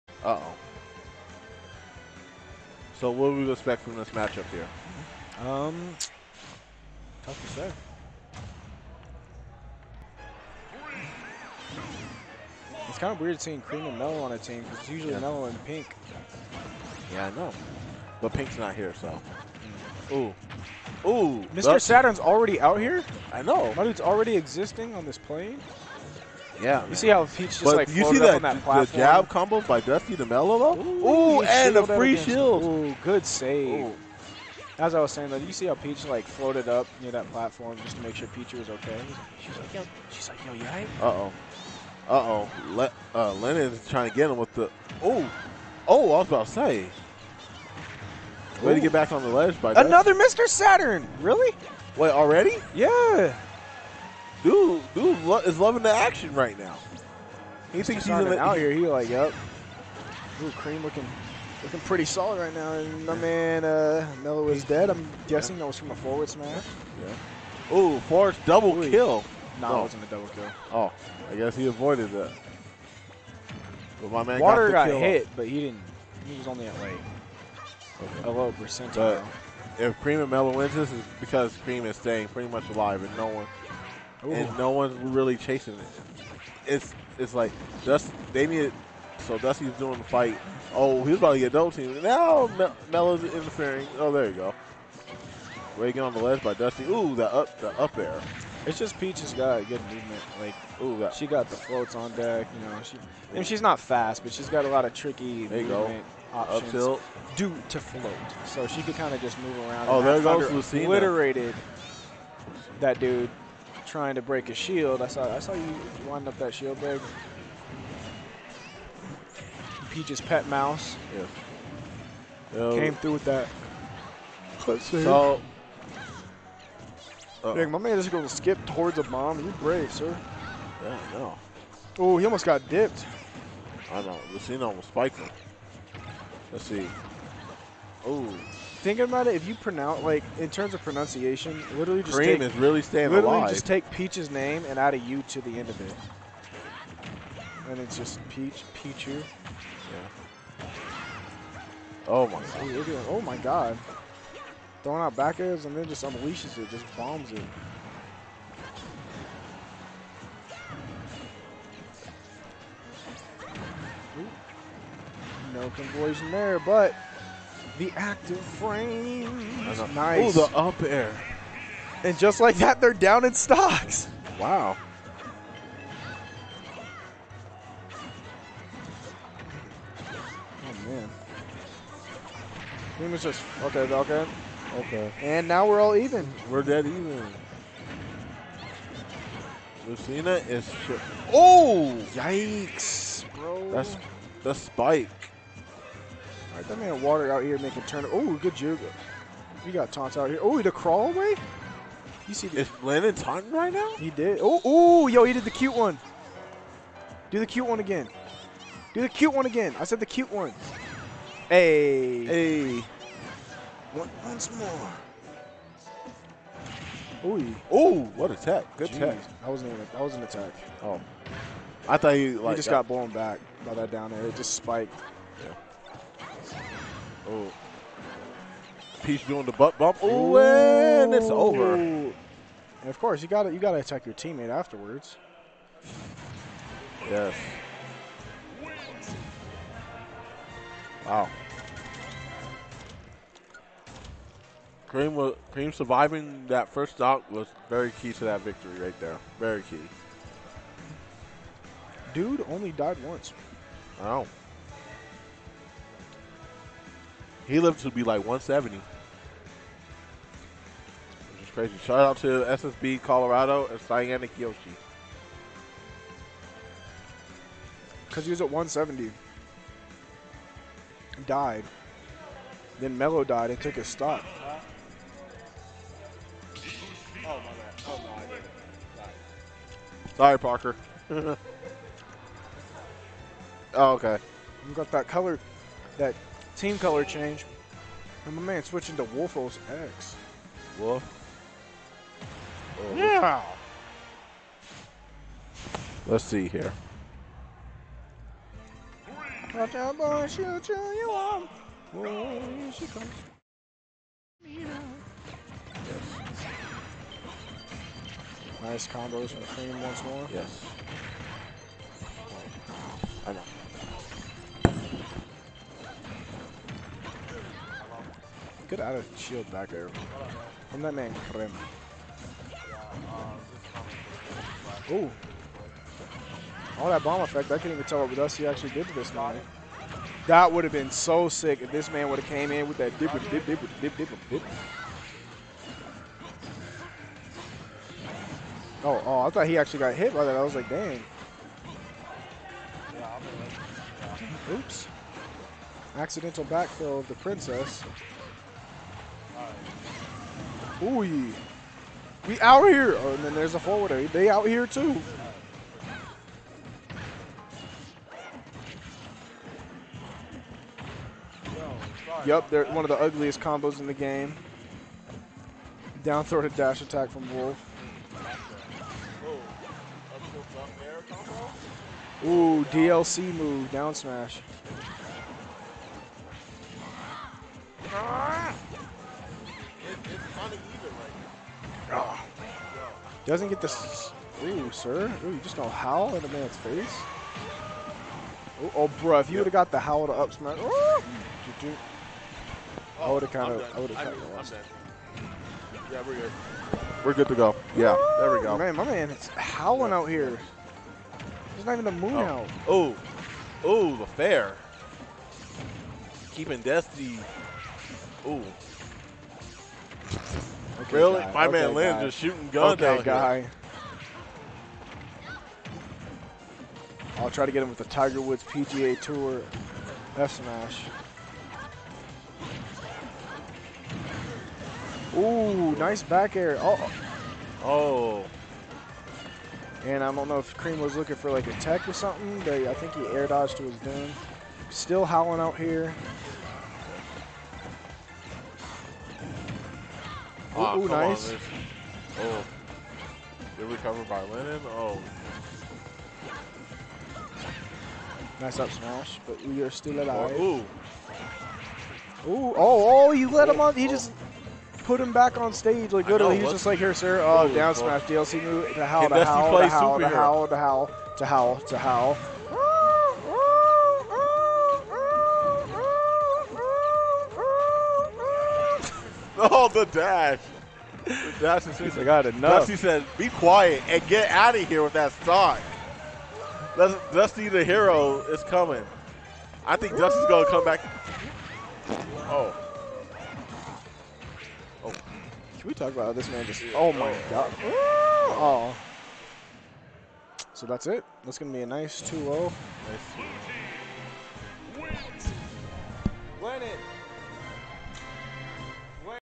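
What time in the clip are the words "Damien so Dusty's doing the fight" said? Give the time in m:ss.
1:28.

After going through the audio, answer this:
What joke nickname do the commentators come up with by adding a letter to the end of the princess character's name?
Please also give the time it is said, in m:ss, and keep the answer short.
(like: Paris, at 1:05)
Peachu, at 2:28.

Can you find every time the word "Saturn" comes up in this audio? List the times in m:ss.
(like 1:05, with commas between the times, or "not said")
0:21, 0:50.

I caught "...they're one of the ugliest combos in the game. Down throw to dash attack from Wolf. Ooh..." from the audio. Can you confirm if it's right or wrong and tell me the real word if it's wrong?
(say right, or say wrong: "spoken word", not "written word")
right.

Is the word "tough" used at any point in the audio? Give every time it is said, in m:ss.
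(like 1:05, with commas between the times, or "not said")
0:07.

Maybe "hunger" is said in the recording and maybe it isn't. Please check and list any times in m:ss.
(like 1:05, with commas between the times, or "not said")
not said.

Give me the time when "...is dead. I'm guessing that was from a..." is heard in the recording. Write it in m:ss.
1:04.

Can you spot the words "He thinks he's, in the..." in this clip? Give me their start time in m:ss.
0:57.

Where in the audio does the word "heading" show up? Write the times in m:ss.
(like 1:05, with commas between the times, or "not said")
not said.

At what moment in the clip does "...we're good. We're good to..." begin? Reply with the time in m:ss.
6:36.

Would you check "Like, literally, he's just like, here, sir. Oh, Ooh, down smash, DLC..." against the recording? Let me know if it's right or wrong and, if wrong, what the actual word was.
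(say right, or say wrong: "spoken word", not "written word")
right.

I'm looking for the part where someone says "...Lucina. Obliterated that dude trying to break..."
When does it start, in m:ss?
1:50.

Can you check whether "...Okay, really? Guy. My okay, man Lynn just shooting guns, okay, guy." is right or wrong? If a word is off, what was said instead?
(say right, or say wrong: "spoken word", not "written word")
right.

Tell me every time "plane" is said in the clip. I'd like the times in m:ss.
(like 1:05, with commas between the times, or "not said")
0:25.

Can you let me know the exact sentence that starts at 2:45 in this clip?
No conversion there, but the active frame.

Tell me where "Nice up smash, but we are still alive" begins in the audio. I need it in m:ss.
7:28.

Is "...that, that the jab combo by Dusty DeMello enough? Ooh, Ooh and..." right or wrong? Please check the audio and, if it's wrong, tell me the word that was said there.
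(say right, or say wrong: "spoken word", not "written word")
wrong: "though", not "enough".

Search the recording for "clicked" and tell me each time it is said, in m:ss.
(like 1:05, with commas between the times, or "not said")
not said.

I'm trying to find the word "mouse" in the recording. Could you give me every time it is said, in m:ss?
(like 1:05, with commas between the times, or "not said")
2:00.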